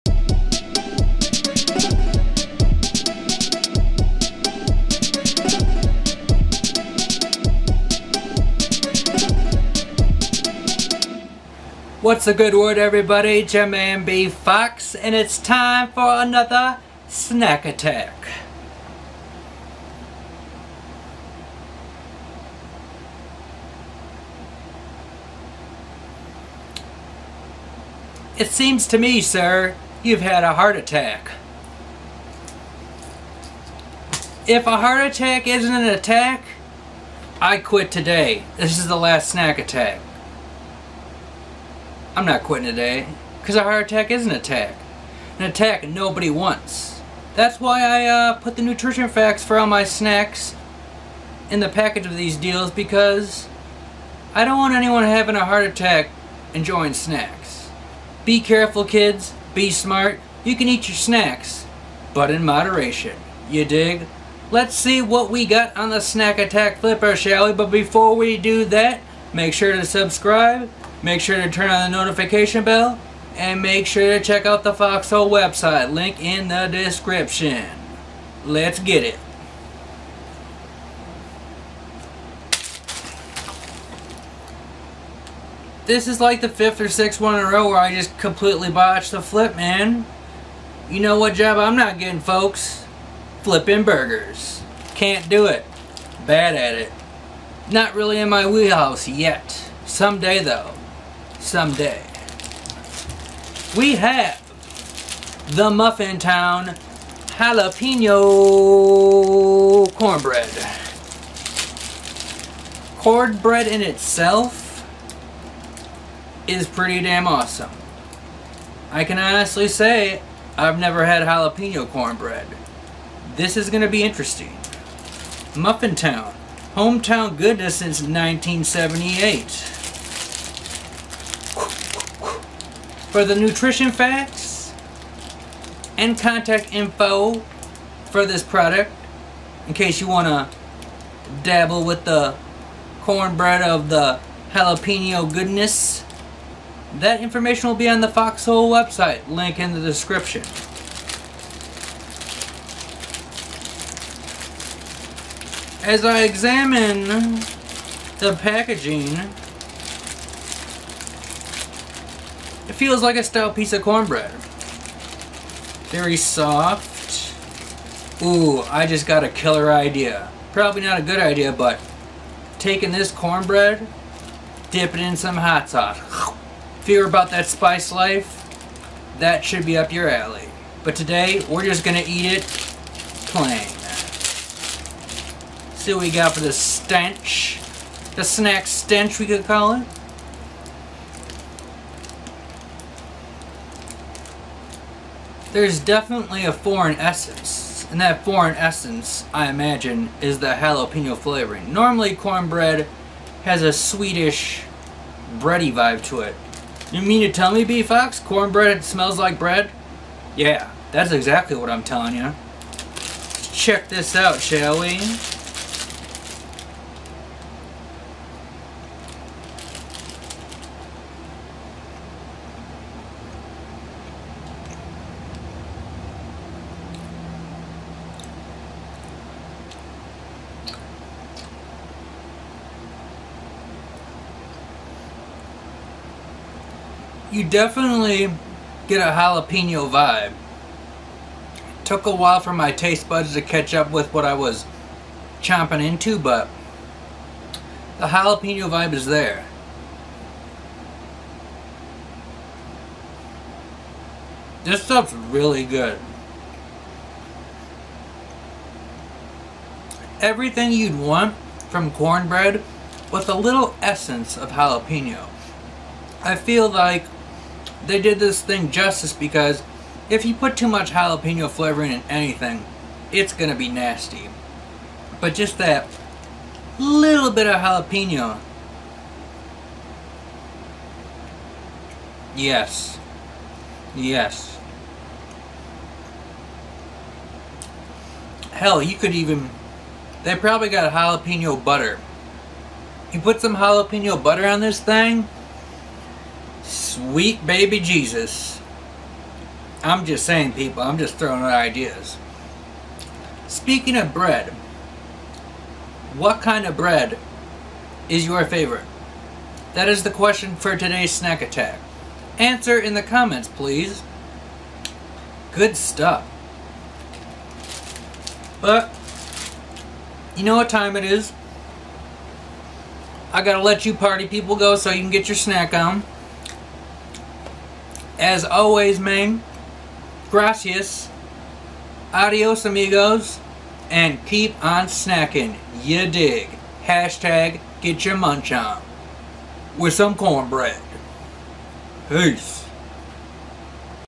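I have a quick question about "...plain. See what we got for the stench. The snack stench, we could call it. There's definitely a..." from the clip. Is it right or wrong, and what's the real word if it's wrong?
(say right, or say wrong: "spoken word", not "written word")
right.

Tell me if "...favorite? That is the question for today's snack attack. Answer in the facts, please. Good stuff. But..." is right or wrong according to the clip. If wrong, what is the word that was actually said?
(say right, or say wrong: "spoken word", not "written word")
wrong: "comments", not "facts".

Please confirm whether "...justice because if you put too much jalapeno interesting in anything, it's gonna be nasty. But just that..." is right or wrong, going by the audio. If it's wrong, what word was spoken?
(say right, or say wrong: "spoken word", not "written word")
wrong: "flavoring", not "interesting".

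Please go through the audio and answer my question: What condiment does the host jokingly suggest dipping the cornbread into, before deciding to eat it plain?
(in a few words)
hot sauce.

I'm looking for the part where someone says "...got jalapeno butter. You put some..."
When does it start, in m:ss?
4:50.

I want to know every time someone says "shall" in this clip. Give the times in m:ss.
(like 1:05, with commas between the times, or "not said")
1:07, 3:34.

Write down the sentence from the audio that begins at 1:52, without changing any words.
Cornbread in itself is pretty damn awesome.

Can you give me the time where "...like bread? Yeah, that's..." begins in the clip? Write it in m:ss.
3:29.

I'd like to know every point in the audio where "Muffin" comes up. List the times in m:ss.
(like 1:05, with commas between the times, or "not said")
1:45, 2:05.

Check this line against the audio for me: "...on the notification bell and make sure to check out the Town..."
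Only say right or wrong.
wrong.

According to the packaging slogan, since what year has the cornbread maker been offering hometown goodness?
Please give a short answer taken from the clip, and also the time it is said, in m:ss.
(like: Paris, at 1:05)
1978, at 2:08.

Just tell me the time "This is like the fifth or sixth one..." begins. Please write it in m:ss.
1:25.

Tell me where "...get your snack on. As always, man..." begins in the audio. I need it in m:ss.
5:25.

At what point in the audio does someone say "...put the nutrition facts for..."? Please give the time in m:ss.
0:48.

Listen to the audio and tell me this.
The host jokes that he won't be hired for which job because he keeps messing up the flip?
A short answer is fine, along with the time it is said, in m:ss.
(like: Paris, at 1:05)
Flipping burgers, at 1:33.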